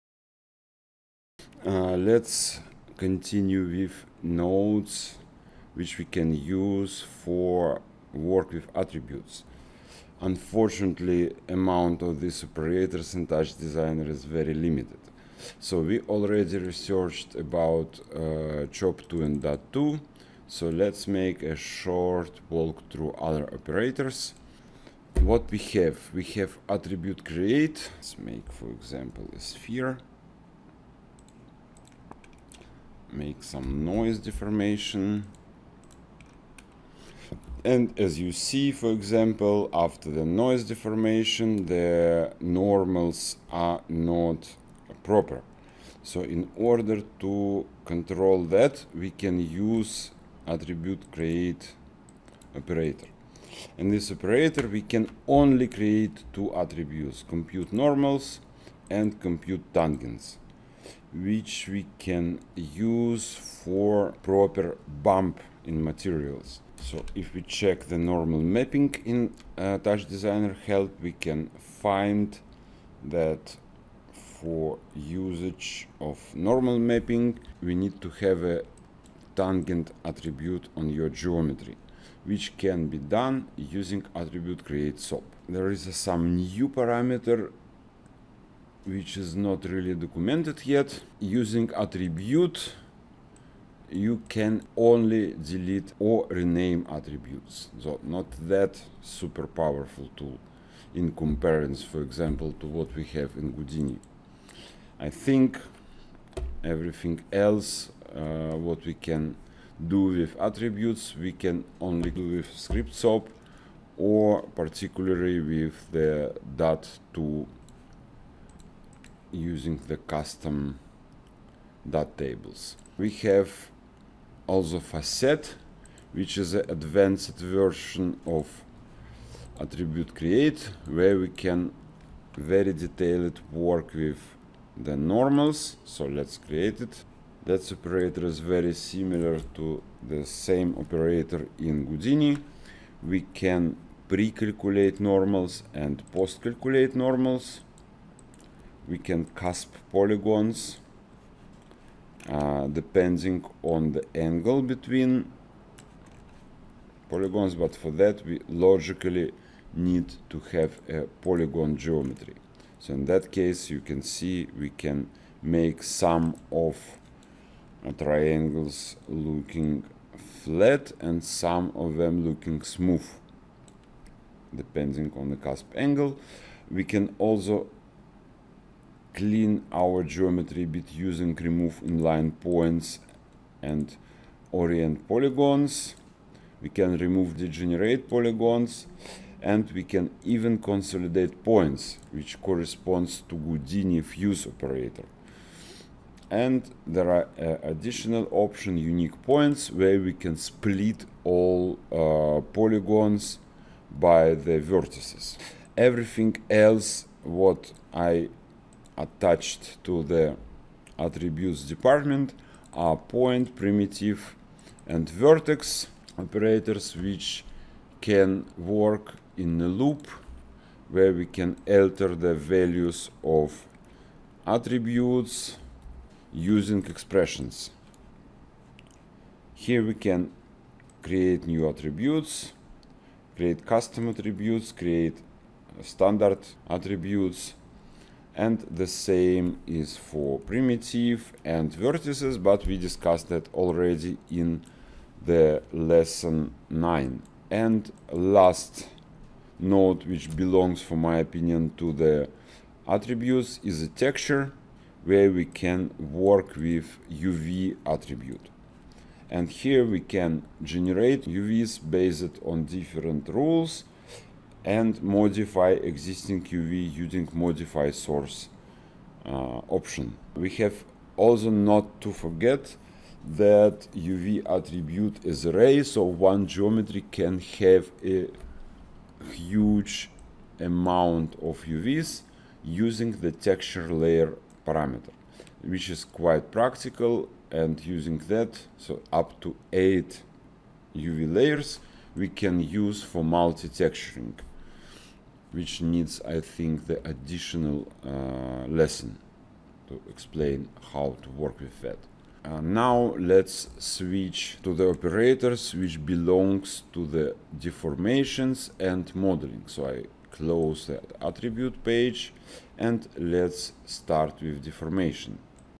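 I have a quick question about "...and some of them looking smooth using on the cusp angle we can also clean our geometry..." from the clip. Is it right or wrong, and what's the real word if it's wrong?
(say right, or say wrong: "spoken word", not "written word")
wrong: "depending", not "using".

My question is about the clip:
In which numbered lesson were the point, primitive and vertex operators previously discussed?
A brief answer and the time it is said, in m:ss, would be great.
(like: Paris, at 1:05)
Lesson 9, at 4:05.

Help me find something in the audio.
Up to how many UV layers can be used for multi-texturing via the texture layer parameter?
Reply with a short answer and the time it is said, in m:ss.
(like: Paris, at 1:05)
8, at 4:49.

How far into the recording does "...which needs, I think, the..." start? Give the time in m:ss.
4:55.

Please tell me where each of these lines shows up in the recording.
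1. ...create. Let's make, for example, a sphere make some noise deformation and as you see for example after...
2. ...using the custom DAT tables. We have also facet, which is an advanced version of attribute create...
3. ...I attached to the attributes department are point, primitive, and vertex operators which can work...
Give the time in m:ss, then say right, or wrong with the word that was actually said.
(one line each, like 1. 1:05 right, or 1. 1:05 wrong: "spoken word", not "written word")
1. 0:27 right
2. 1:59 right
3. 3:27 right.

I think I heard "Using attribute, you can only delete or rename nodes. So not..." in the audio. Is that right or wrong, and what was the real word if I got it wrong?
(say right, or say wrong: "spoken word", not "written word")
wrong: "attributes", not "nodes".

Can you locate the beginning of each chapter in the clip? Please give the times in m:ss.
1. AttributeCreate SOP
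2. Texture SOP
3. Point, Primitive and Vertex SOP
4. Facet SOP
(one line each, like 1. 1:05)
1. 0:23
2. 4:07
3. 3:42
4. 2:07.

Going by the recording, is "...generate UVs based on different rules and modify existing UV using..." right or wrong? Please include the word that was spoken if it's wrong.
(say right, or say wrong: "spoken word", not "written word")
right.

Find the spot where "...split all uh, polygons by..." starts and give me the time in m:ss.
3:20.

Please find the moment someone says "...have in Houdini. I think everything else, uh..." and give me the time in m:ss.
1:43.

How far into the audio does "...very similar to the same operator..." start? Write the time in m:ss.
2:18.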